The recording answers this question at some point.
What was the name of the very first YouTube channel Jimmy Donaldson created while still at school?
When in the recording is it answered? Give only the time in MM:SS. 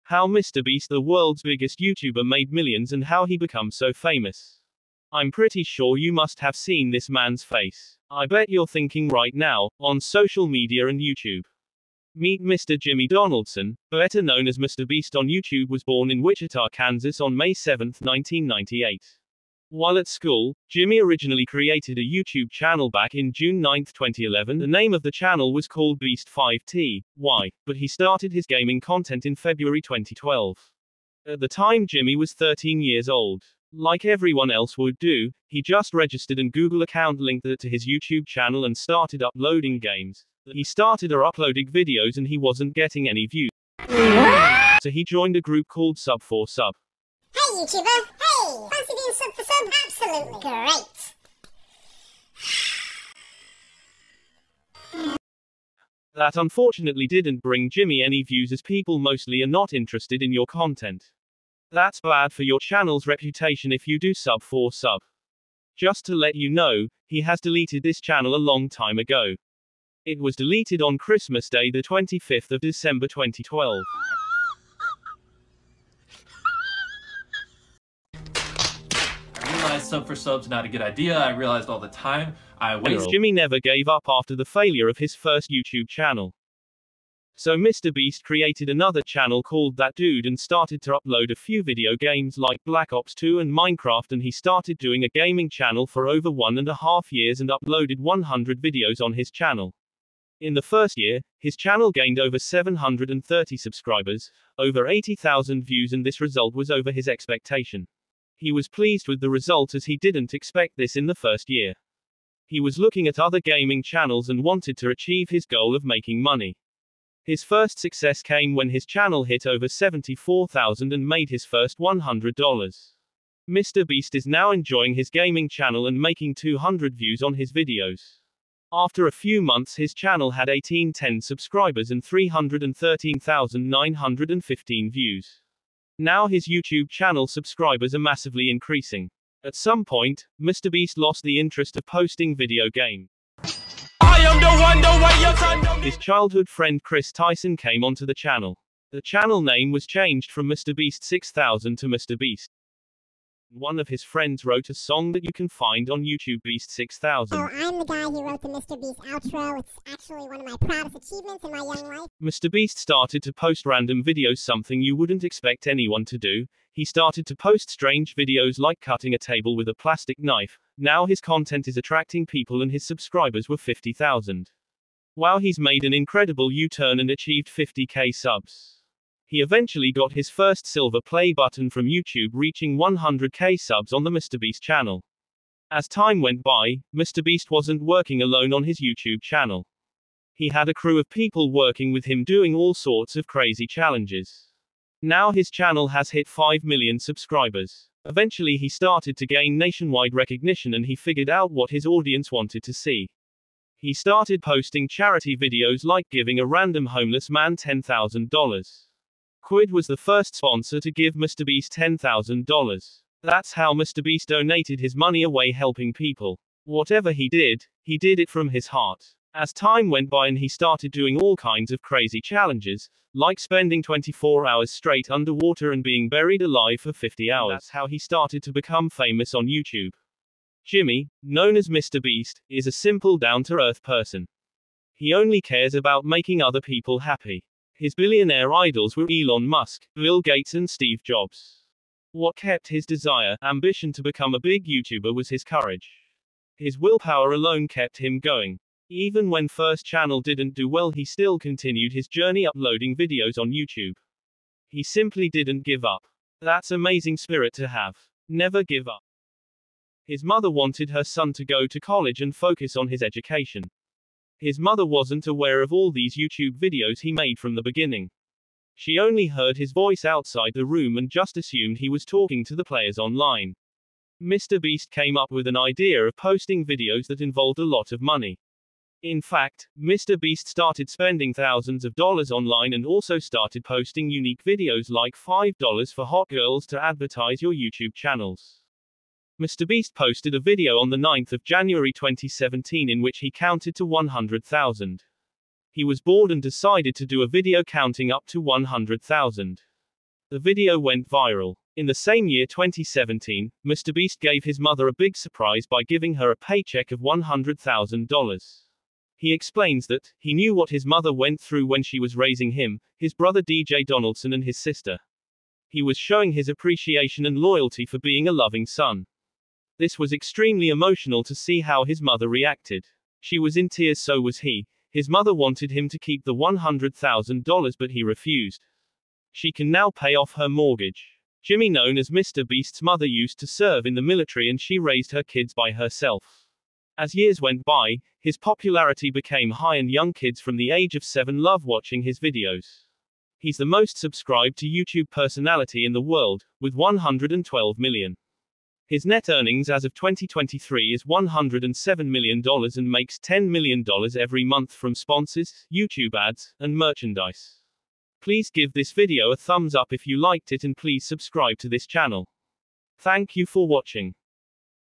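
00:25.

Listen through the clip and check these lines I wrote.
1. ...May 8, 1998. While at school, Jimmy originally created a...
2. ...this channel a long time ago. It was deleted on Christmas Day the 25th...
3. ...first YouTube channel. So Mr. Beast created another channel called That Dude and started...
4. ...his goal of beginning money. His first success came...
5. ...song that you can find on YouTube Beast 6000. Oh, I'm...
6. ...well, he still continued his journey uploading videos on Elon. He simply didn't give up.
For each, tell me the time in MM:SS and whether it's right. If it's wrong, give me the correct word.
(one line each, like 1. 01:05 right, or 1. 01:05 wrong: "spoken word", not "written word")
1. 00:17 wrong: "7", not "8"
2. 01:07 right
3. 01:25 right
4. 01:55 wrong: "making", not "beginning"
5. 02:34 right
6. 04:10 wrong: "YouTube", not "Elon".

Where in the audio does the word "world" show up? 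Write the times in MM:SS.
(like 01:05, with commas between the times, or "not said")
00:00, 05:46.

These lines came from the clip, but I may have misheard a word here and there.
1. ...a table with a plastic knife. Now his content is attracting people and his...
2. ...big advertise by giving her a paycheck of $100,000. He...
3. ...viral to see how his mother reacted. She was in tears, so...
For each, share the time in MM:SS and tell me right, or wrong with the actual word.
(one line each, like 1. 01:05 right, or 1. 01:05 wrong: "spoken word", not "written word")
1. 02:49 right
2. 05:04 wrong: "surprise", not "advertise"
3. 05:20 wrong: "emotional", not "viral".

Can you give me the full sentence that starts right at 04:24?
His mother wasn't aware of all these YouTube videos he made from the beginning.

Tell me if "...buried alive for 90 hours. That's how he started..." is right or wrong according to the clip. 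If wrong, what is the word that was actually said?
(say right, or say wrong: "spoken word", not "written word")
wrong: "50", not "90".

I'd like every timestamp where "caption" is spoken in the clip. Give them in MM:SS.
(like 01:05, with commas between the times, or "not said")
not said.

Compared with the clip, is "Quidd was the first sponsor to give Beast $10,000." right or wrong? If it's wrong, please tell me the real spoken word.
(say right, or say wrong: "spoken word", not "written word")
wrong: "MrBeast", not "Beast".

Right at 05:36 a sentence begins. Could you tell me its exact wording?
As years went by, his popularity became high and young kids from the age of seven love watching his videos.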